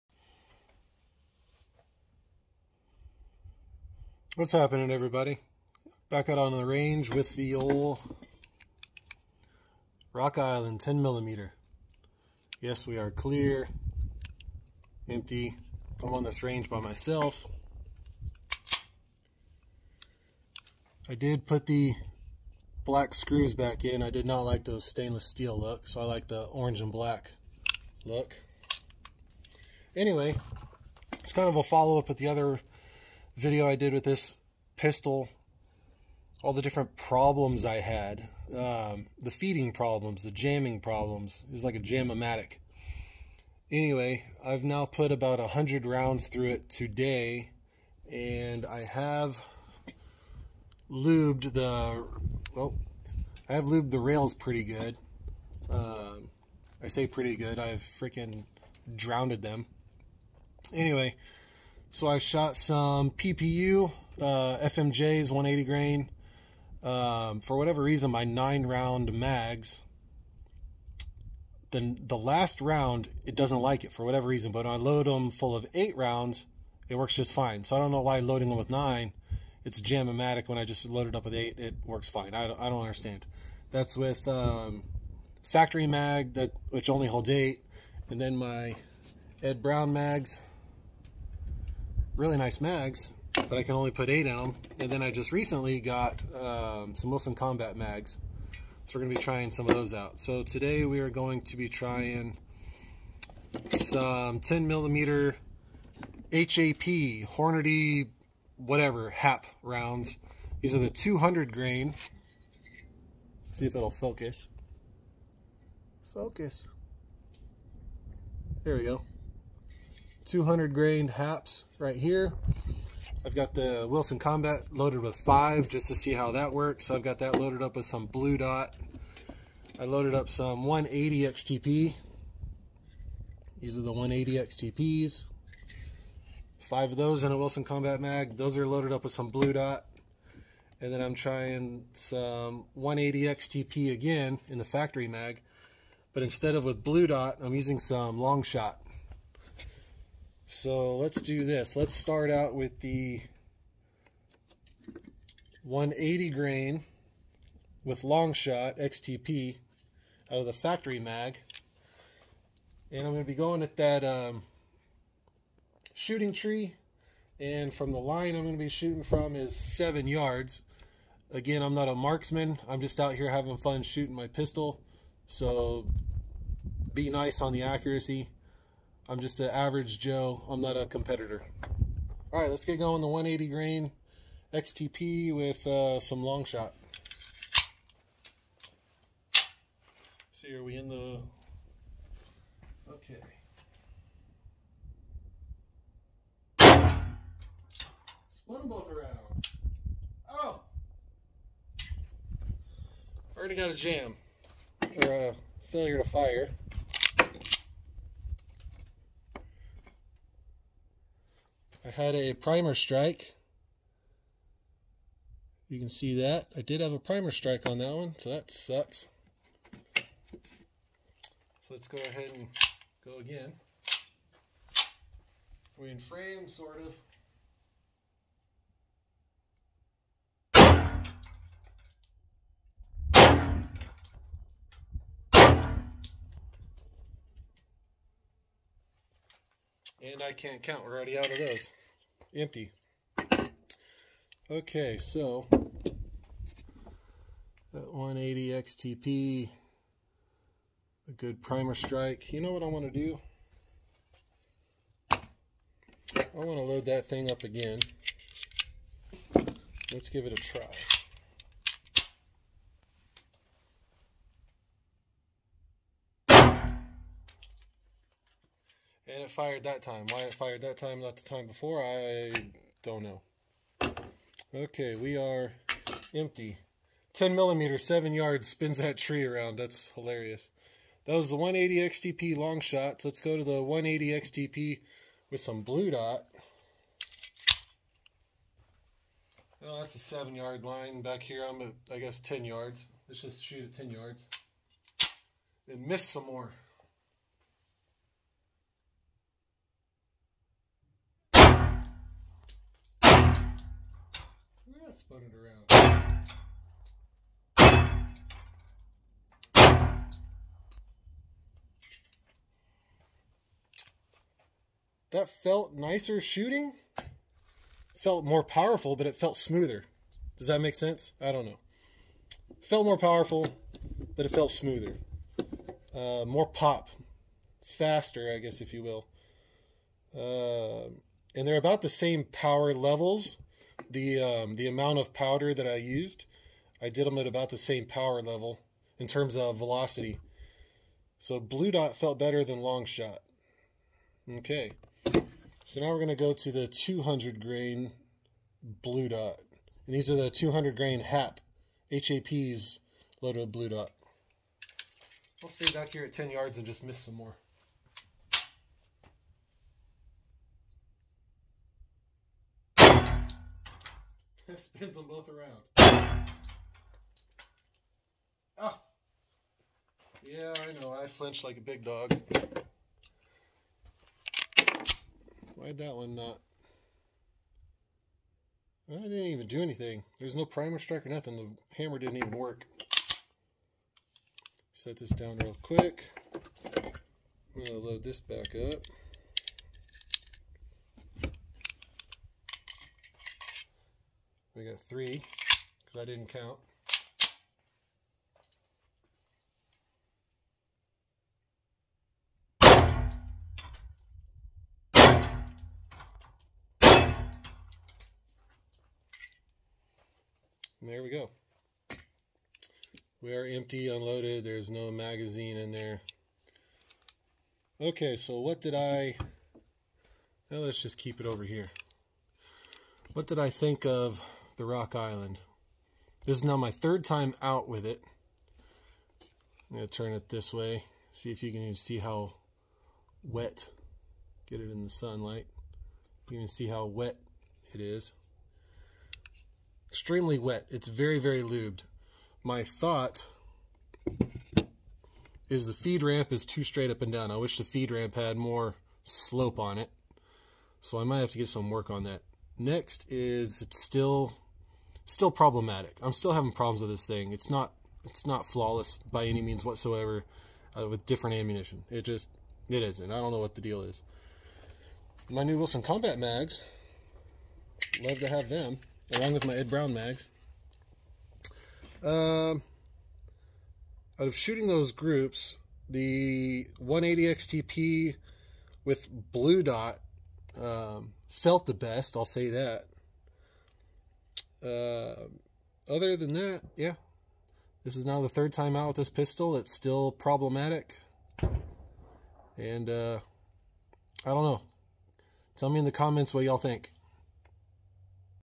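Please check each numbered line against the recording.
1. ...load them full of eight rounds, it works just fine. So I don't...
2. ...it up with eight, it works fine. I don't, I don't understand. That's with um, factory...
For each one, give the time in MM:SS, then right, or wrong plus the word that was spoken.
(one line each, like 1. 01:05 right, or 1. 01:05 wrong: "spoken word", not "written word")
1. 01:14 right
2. 01:21 right.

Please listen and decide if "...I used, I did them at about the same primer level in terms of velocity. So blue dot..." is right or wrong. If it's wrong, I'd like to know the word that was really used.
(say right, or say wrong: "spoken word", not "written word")
wrong: "power", not "primer".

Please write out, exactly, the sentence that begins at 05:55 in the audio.
I'll stay back here at 10 yards and just miss some more.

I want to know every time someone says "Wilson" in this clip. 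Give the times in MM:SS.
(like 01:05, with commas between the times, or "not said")
01:37, 02:03, 02:17, 07:45.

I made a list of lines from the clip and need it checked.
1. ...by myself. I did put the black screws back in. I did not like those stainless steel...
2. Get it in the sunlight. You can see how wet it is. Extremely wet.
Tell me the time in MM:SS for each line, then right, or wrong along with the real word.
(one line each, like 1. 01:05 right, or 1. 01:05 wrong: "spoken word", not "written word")
1. 00:16 right
2. 07:14 right.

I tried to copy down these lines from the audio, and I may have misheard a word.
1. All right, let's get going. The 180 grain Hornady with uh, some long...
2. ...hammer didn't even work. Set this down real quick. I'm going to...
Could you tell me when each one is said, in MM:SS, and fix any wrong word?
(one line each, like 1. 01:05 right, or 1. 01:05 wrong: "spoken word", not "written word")
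1. 03:02 wrong: "XTP", not "Hornady"
2. 06:21 right.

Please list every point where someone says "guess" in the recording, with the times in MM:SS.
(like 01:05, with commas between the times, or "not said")
04:51, 05:28.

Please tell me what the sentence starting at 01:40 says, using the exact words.
So today we are going to be trying some 10 millimeter HAP, Hornady, whatever, HAP rounds.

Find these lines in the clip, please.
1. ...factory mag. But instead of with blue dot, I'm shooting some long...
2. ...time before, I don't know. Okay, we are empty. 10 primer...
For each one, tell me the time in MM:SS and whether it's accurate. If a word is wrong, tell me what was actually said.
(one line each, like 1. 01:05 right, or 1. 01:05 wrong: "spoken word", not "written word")
1. 02:24 wrong: "using", not "shooting"
2. 04:31 wrong: "millimeter", not "primer".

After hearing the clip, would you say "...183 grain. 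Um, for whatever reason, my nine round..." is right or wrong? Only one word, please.
wrong.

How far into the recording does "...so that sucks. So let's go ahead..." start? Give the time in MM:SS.
03:38.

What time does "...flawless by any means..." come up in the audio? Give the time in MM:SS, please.
07:38.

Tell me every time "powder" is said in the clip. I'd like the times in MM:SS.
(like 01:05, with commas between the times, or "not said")
05:35.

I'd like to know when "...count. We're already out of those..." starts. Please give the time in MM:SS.
04:00.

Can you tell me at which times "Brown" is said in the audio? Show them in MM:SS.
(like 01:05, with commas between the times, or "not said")
01:29, 07:49.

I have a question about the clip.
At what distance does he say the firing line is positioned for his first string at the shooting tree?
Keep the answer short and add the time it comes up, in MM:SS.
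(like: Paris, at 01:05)
7 yards, at 02:49.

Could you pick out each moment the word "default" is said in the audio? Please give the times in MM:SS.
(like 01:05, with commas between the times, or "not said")
not said.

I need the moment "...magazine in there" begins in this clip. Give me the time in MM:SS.
06:54.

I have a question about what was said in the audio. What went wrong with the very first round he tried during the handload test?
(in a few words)
failure to fire.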